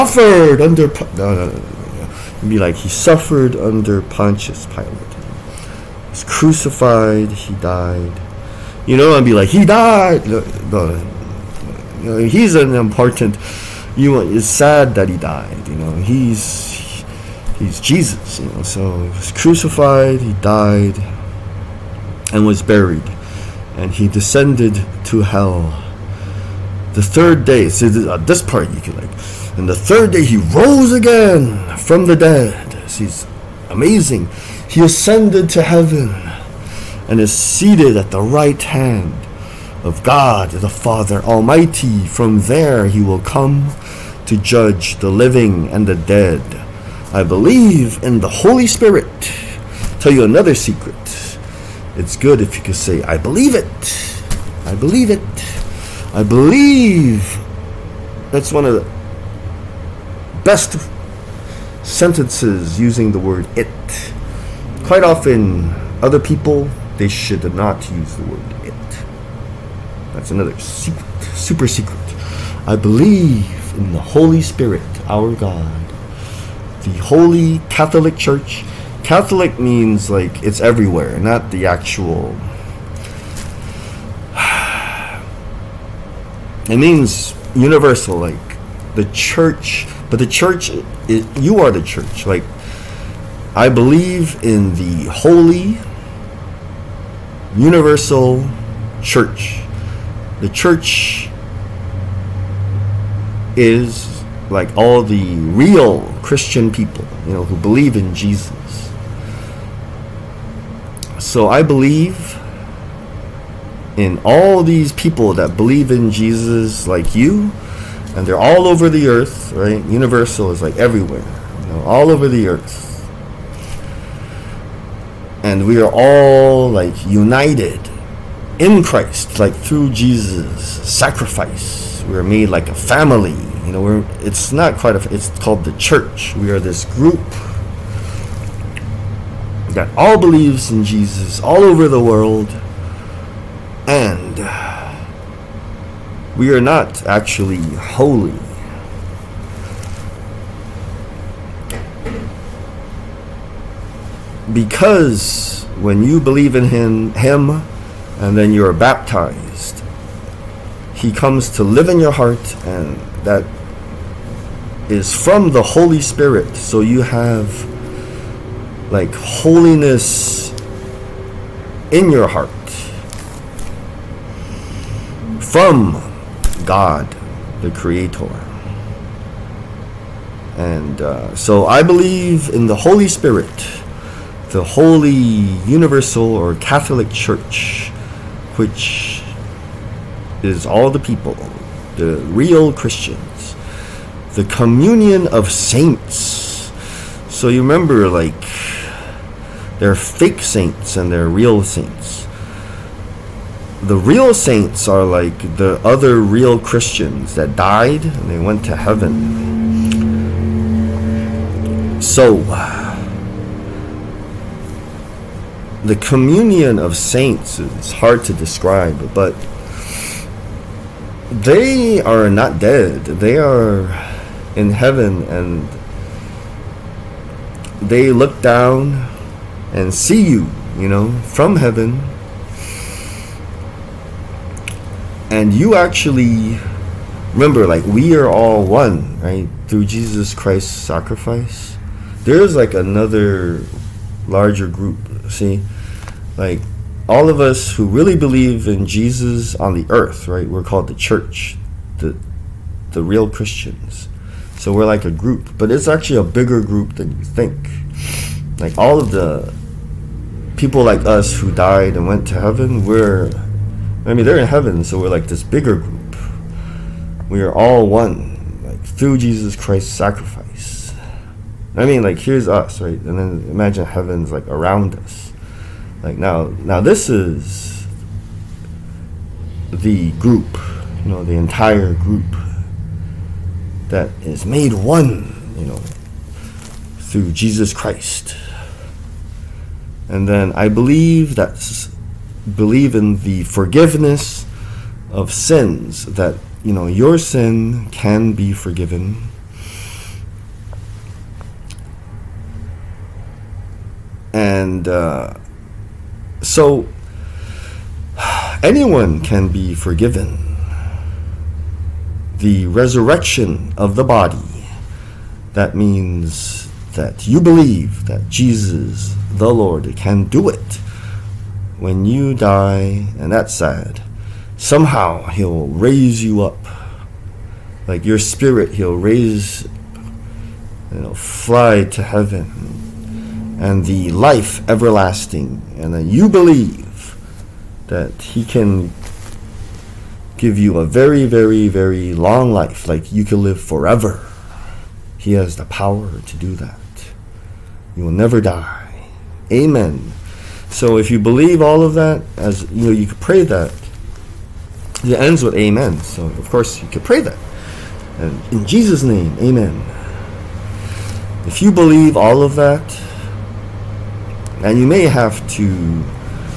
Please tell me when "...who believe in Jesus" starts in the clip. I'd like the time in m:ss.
1:47.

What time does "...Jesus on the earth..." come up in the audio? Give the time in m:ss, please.
4:08.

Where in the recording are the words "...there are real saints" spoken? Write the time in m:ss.
3:21.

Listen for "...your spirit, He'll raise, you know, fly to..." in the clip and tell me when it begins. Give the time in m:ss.
5:28.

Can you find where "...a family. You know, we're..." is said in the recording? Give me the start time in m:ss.
2:12.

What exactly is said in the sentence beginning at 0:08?
You know, and be like he died.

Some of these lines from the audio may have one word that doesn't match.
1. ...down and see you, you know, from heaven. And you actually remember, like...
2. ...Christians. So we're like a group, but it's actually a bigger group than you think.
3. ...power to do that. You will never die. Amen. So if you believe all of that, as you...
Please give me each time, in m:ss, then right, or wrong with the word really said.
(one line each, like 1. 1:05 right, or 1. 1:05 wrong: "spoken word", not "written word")
1. 3:48 right
2. 4:13 right
3. 5:45 right.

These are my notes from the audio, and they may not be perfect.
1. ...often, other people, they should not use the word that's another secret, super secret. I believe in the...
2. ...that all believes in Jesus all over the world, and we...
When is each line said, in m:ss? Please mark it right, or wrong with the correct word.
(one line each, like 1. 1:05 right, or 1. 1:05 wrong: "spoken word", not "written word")
1. 1:05 right
2. 2:19 right.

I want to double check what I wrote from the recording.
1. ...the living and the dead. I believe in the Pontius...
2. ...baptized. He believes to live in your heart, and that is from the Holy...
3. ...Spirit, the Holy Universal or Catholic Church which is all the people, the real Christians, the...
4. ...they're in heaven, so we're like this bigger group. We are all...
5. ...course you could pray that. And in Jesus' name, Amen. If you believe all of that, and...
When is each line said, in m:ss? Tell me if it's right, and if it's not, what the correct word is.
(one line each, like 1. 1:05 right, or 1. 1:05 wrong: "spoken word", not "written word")
1. 0:44 wrong: "Holy", not "Pontius"
2. 2:38 wrong: "comes", not "believes"
3. 3:03 right
4. 4:24 right
5. 5:56 right.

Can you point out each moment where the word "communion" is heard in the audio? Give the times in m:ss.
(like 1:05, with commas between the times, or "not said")
3:14, 3:35.